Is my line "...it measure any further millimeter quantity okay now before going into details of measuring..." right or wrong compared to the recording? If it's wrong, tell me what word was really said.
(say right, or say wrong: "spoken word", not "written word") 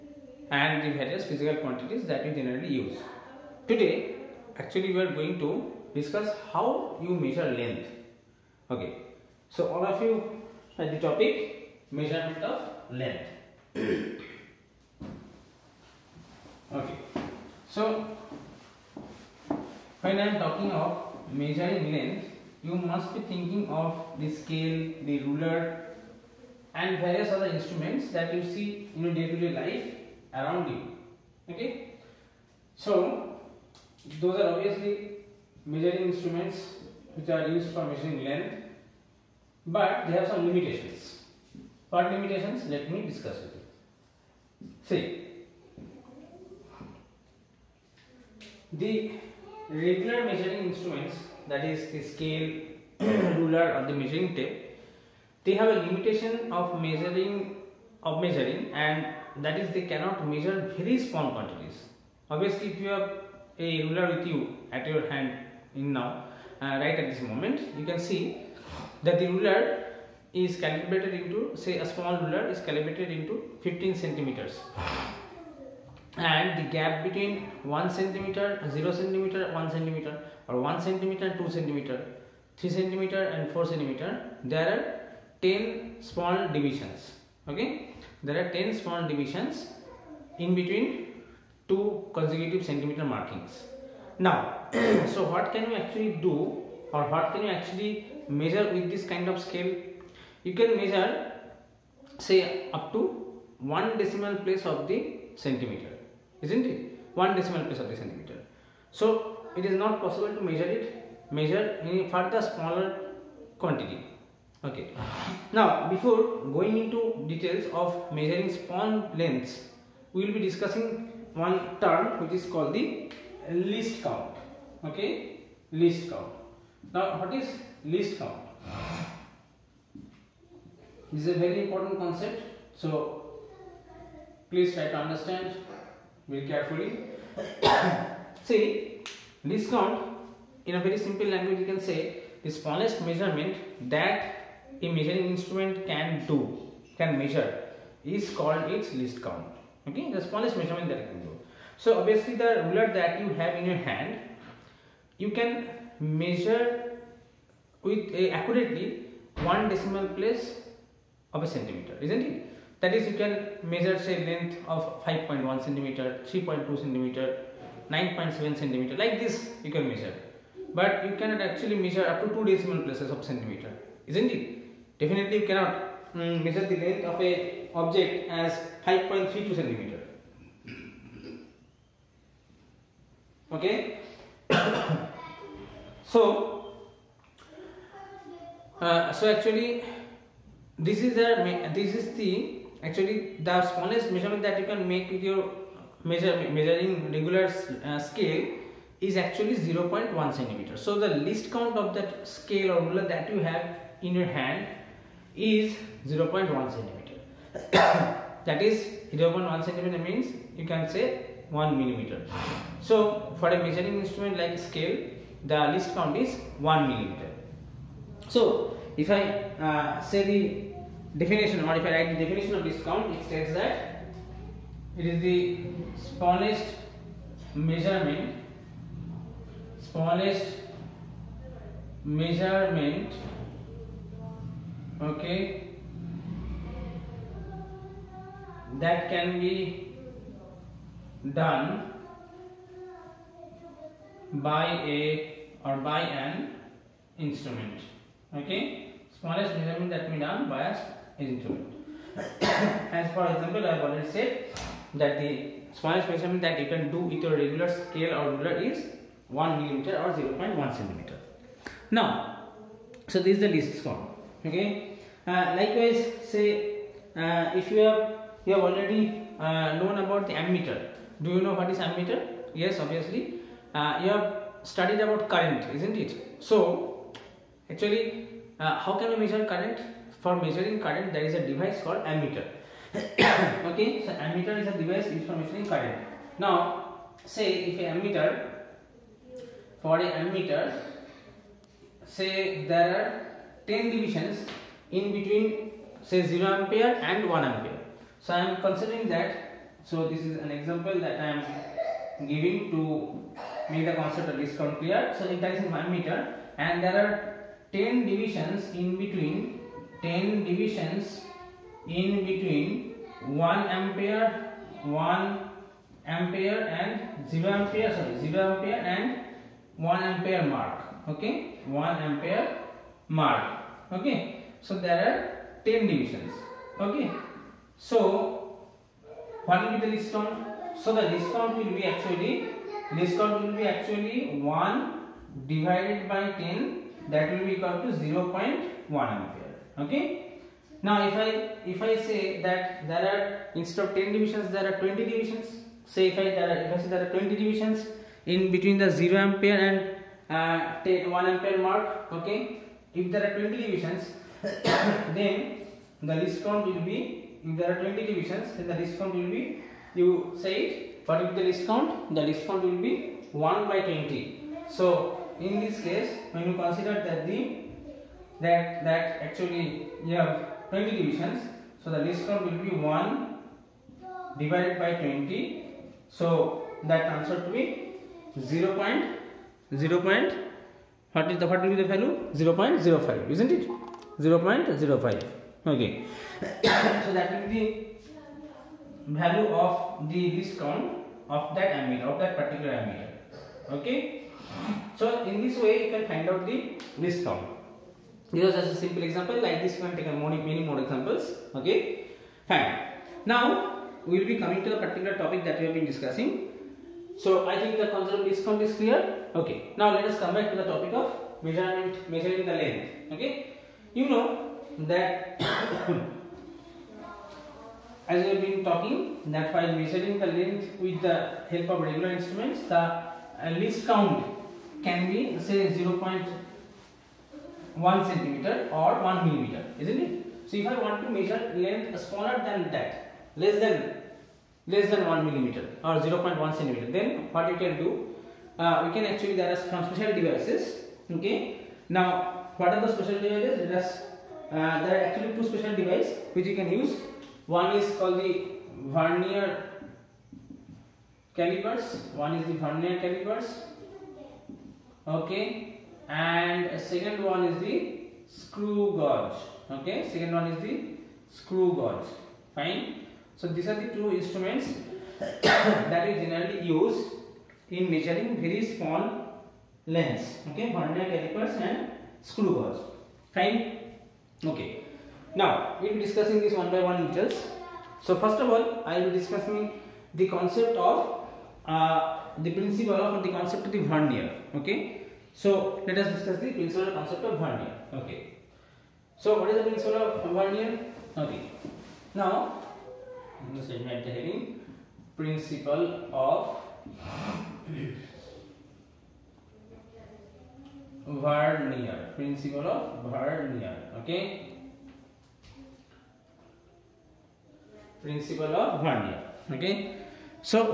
wrong: "smaller", not "millimeter".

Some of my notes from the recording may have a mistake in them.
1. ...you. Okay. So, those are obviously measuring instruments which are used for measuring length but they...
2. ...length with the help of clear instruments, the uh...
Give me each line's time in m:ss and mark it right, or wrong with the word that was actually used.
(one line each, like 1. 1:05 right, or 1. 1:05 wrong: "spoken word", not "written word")
1. 0:30 right
2. 7:00 wrong: "regular", not "clear".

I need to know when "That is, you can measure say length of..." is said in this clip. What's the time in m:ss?
2:42.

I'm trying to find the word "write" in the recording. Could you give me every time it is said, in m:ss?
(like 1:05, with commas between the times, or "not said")
3:41.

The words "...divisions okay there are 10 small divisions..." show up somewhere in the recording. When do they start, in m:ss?
1:26.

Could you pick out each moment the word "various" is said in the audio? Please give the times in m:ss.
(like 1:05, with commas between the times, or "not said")
0:00, 0:26.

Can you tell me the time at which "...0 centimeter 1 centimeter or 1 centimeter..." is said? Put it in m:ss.
1:18.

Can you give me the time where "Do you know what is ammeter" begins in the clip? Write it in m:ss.
4:31.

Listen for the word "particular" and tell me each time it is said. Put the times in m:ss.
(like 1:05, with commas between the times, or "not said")
6:32, 6:44.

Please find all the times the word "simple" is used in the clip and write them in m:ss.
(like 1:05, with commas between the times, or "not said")
2:20, 6:38.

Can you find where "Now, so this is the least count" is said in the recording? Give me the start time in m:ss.
4:21.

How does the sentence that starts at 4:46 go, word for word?
Now, say if a ammeter, for a ammeter, say there are 10 divisions in between say 0 ampere and 1 ampere.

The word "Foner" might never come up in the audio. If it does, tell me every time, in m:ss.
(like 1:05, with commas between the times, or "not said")
not said.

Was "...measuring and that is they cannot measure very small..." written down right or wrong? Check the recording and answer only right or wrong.
right.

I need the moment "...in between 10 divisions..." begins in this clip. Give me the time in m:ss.
5:08.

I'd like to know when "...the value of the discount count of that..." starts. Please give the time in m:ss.
6:29.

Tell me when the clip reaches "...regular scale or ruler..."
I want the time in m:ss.
4:17.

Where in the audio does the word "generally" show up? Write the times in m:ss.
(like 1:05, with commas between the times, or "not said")
0:02, 7:46.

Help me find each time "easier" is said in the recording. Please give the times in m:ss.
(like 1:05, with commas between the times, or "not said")
not said.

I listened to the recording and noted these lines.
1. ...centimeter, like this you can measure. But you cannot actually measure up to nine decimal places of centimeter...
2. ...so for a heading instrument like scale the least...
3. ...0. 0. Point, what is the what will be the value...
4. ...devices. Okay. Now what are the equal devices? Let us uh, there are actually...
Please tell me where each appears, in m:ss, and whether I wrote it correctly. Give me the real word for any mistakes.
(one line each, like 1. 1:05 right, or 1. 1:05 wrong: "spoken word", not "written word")
1. 2:48 wrong: "two", not "nine"
2. 3:32 wrong: "measuring", not "heading"
3. 6:18 right
4. 7:20 wrong: "special", not "equal".